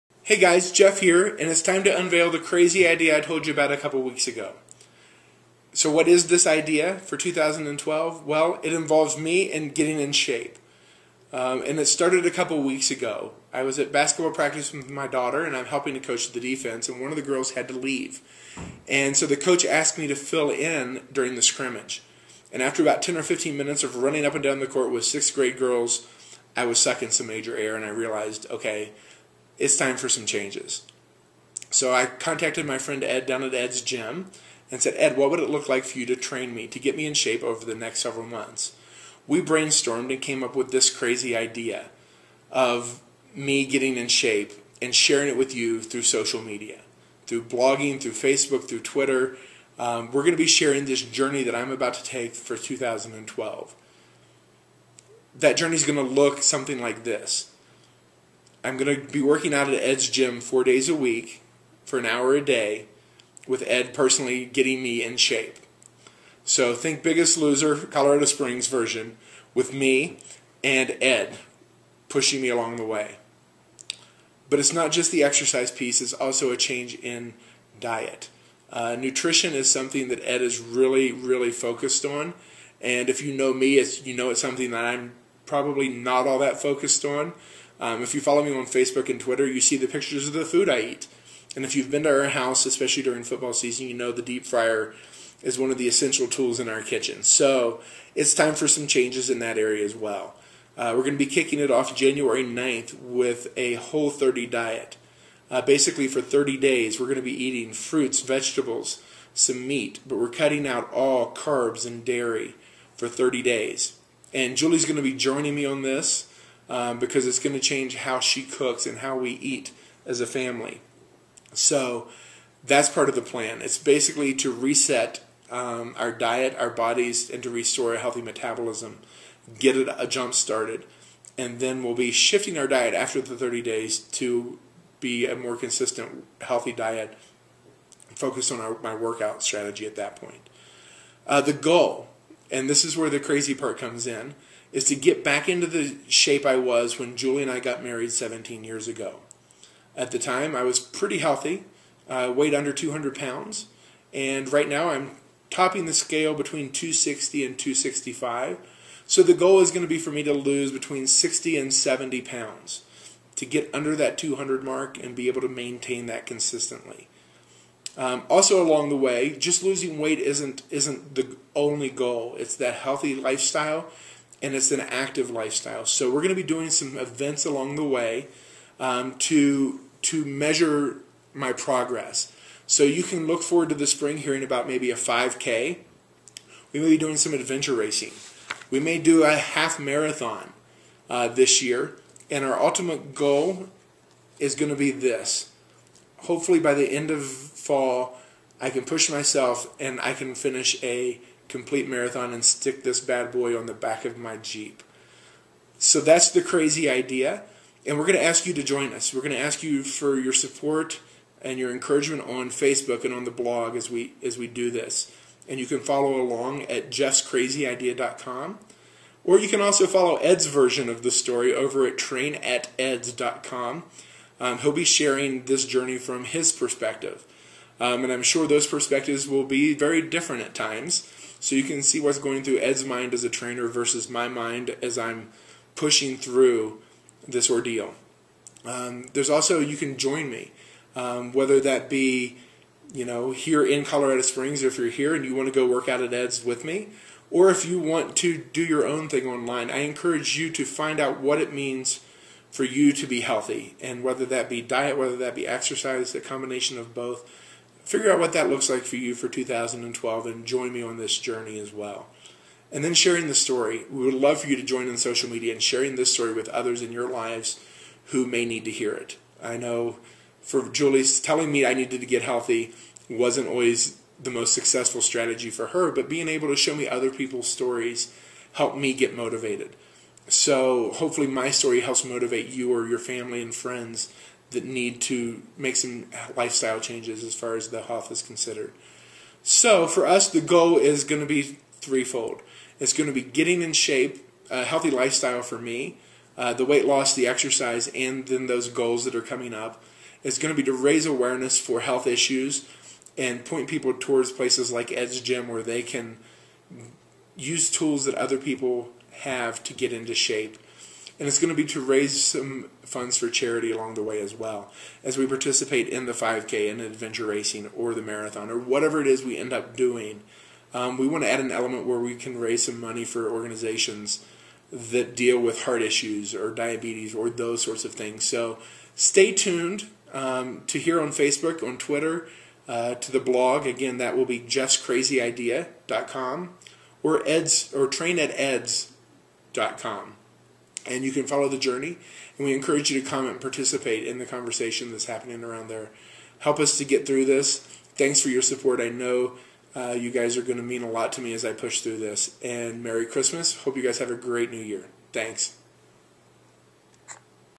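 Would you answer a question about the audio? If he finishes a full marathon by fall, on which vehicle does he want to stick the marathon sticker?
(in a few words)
Jeep.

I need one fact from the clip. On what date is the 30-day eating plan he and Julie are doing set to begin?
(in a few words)
January 9.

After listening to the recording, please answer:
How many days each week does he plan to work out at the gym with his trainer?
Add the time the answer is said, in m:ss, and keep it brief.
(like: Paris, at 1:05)
4, at 1:00.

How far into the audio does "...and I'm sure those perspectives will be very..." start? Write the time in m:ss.
3:48.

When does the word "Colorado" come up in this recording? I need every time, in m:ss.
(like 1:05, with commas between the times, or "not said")
1:07, 4:03.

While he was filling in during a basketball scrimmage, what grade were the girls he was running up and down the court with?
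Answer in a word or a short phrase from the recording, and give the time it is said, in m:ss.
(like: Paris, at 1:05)
6th grade, at 0:25.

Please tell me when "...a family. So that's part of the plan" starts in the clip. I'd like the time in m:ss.
2:00.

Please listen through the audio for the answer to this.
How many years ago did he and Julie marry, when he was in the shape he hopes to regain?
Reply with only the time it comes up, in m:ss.
2:28.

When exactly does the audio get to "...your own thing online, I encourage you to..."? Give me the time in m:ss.
4:08.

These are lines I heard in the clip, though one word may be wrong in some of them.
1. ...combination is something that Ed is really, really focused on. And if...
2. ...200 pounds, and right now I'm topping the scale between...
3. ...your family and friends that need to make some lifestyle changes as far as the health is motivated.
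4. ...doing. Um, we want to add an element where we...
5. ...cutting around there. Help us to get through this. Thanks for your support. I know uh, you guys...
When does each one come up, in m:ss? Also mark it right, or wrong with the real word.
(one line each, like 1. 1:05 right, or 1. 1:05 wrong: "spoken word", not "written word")
1. 1:18 wrong: "nutrition", not "combination"
2. 2:32 right
3. 4:42 wrong: "considered", not "motivated"
4. 5:19 right
5. 5:45 wrong: "happening", not "cutting".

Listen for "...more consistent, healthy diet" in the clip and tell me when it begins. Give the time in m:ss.
2:15.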